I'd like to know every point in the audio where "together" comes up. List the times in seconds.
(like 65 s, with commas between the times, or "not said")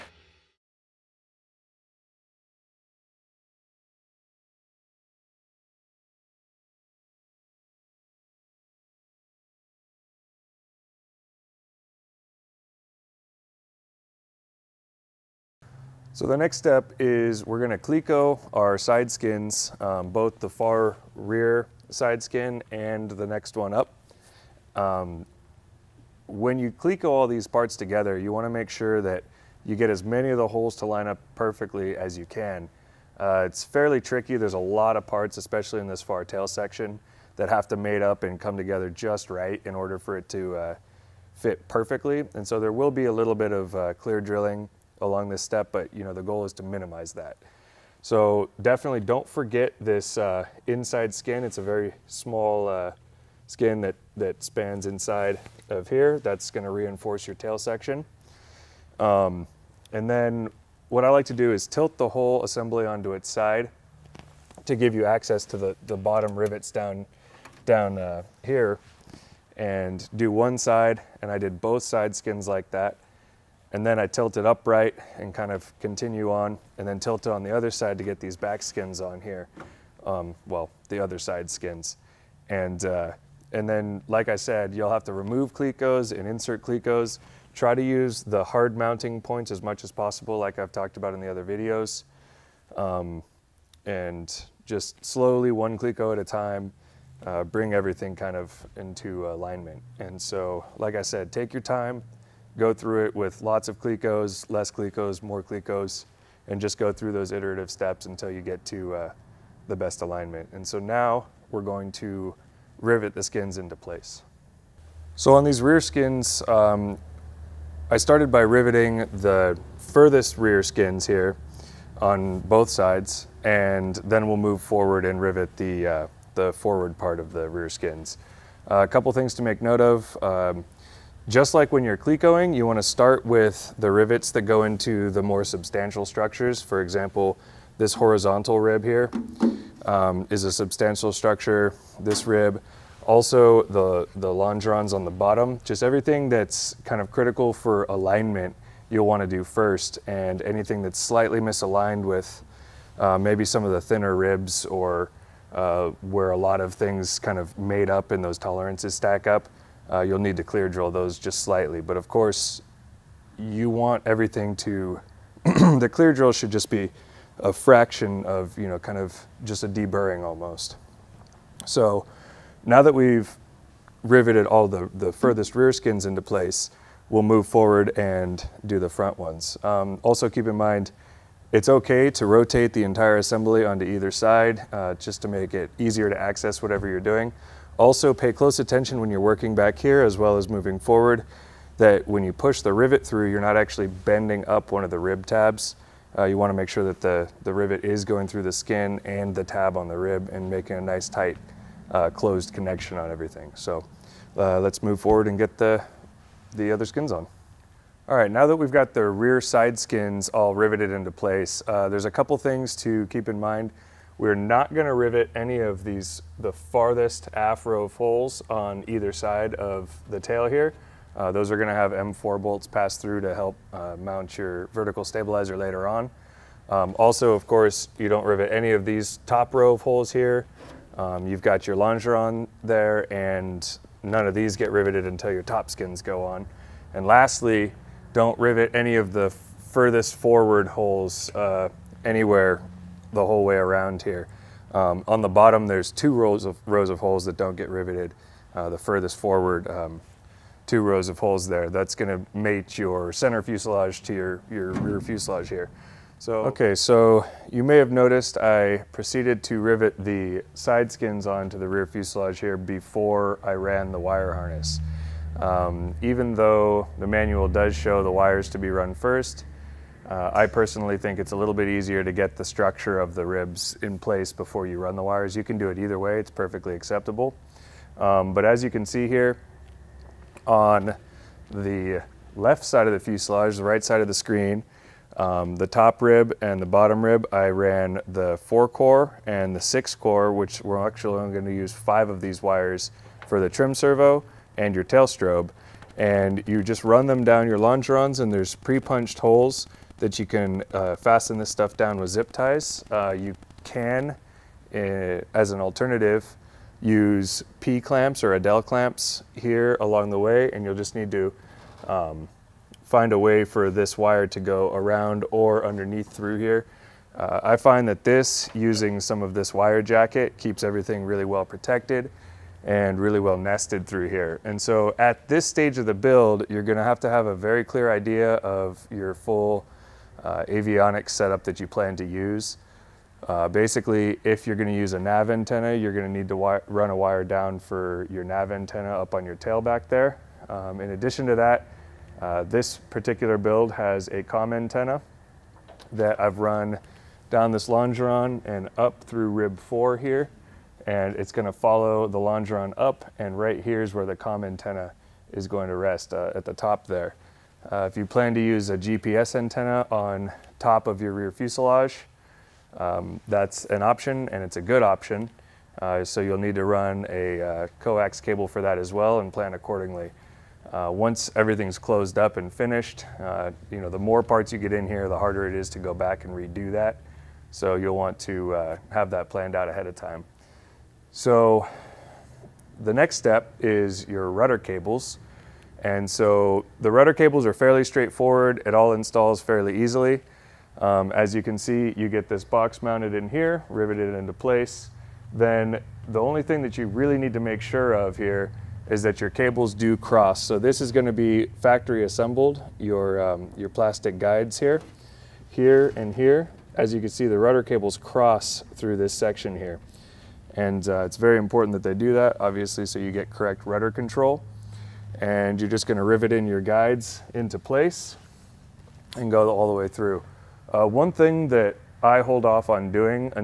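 27 s, 38 s.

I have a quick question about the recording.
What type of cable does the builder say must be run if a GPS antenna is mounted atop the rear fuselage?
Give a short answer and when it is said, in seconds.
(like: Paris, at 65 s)
coax cable, at 367 s.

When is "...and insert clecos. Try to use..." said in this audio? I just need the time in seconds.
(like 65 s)
86 s.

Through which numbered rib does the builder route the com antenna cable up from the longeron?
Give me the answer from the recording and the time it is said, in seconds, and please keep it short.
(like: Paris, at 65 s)
rib 4, at 349 s.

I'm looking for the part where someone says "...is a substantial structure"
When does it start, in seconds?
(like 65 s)
140 s.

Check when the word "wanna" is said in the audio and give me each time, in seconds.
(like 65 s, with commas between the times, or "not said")
28 s, 196 s.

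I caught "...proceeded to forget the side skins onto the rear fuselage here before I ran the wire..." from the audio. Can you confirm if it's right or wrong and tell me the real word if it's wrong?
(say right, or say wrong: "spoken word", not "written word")
wrong: "rivet", not "forget".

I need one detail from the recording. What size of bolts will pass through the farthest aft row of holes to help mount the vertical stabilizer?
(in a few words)
M4.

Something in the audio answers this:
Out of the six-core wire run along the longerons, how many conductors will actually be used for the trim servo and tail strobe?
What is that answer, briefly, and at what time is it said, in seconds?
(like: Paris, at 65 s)
5, at 291 s.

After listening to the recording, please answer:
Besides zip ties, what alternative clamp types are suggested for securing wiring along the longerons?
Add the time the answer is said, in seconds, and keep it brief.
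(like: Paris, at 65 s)
P clamps or Adel clamps, at 307 s.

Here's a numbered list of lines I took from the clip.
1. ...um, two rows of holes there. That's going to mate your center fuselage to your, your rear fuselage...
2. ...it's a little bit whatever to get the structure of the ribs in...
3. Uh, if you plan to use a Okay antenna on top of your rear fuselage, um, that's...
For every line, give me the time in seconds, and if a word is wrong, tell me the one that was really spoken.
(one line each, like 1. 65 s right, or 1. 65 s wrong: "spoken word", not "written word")
1. 249 s right
2. 271 s wrong: "easier", not "whatever"
3. 357 s wrong: "GPS", not "Okay".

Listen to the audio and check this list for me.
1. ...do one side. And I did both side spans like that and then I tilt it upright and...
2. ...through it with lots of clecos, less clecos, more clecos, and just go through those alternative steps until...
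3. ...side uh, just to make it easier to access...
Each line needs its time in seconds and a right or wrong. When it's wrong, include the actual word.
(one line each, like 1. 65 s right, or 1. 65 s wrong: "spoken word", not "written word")
1. 70 s wrong: "skins", not "spans"
2. 102 s wrong: "iterative", not "alternative"
3. 184 s right.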